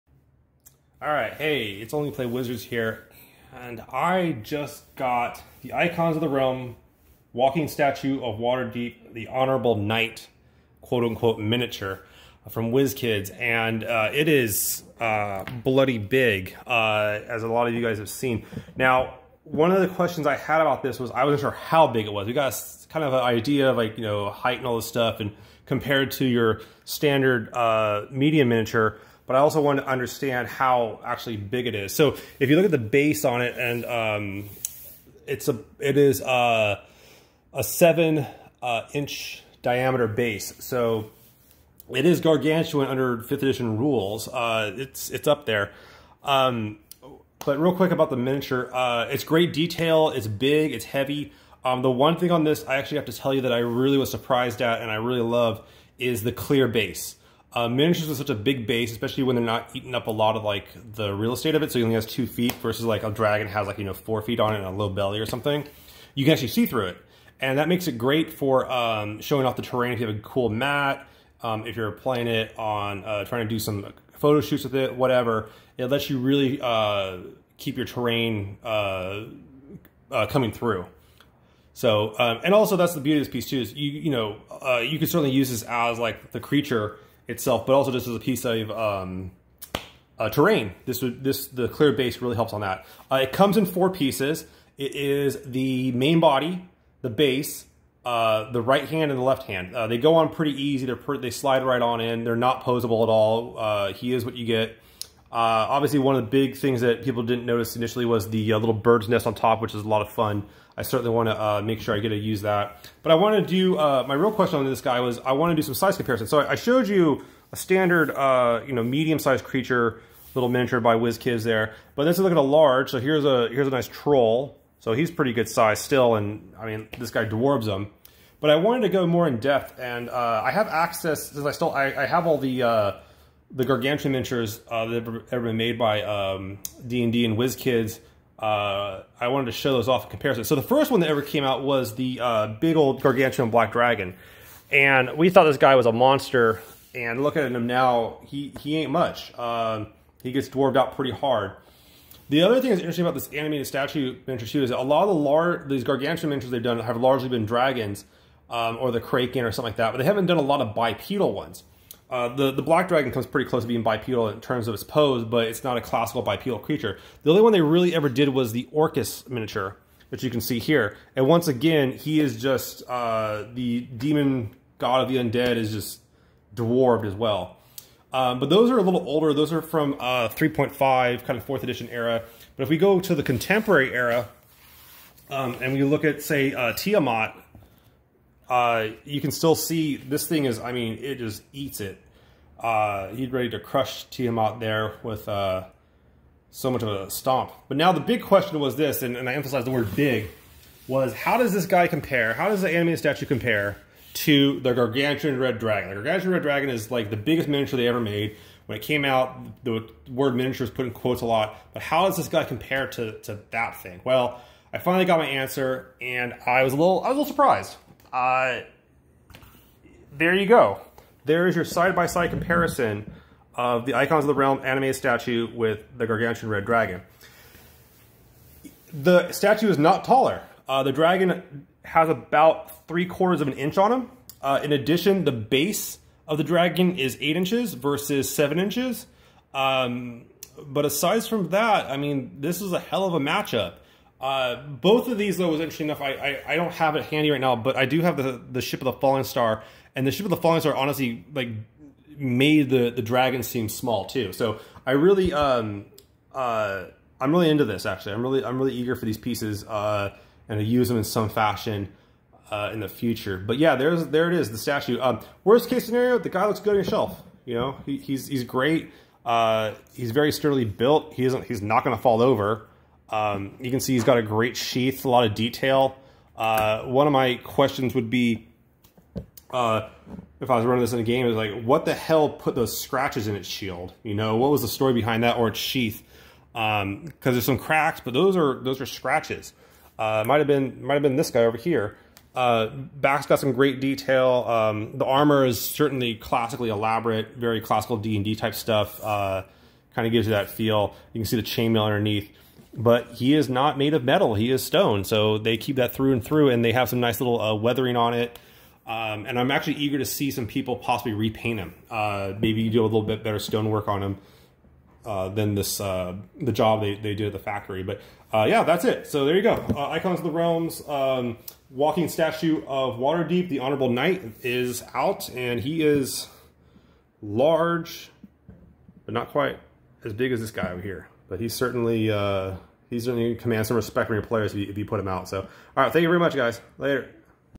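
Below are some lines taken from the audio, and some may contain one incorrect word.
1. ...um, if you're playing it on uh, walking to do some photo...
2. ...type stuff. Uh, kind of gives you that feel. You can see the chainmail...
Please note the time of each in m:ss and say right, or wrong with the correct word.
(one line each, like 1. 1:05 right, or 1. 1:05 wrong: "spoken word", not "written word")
1. 1:11 wrong: "trying", not "walking"
2. 4:58 right.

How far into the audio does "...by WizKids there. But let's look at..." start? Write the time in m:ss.
2:00.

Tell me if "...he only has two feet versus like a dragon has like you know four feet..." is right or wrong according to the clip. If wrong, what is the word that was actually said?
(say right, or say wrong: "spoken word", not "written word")
right.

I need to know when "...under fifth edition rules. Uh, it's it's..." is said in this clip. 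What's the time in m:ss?
0:42.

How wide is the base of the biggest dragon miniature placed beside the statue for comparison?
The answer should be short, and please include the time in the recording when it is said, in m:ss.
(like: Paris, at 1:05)
8 inches, at 3:57.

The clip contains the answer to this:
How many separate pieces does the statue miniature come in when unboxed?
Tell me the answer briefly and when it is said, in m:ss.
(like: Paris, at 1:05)
4, at 1:33.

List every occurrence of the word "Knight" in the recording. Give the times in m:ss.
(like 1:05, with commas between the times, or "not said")
0:09, 5:23.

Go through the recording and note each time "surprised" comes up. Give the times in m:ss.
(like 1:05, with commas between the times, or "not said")
0:54, 3:37.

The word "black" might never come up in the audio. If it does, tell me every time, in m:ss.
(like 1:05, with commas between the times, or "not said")
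2:23, 2:42.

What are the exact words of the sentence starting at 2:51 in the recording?
And once again, he is just uh, the demon god of the undead is just dwarfed as well.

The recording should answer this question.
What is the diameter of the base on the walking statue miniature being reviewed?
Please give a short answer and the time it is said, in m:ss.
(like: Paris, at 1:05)
7 inches, at 0:37.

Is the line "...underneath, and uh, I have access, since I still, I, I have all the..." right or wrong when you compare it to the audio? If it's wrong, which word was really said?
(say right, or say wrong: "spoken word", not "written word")
wrong: "depth", not "underneath".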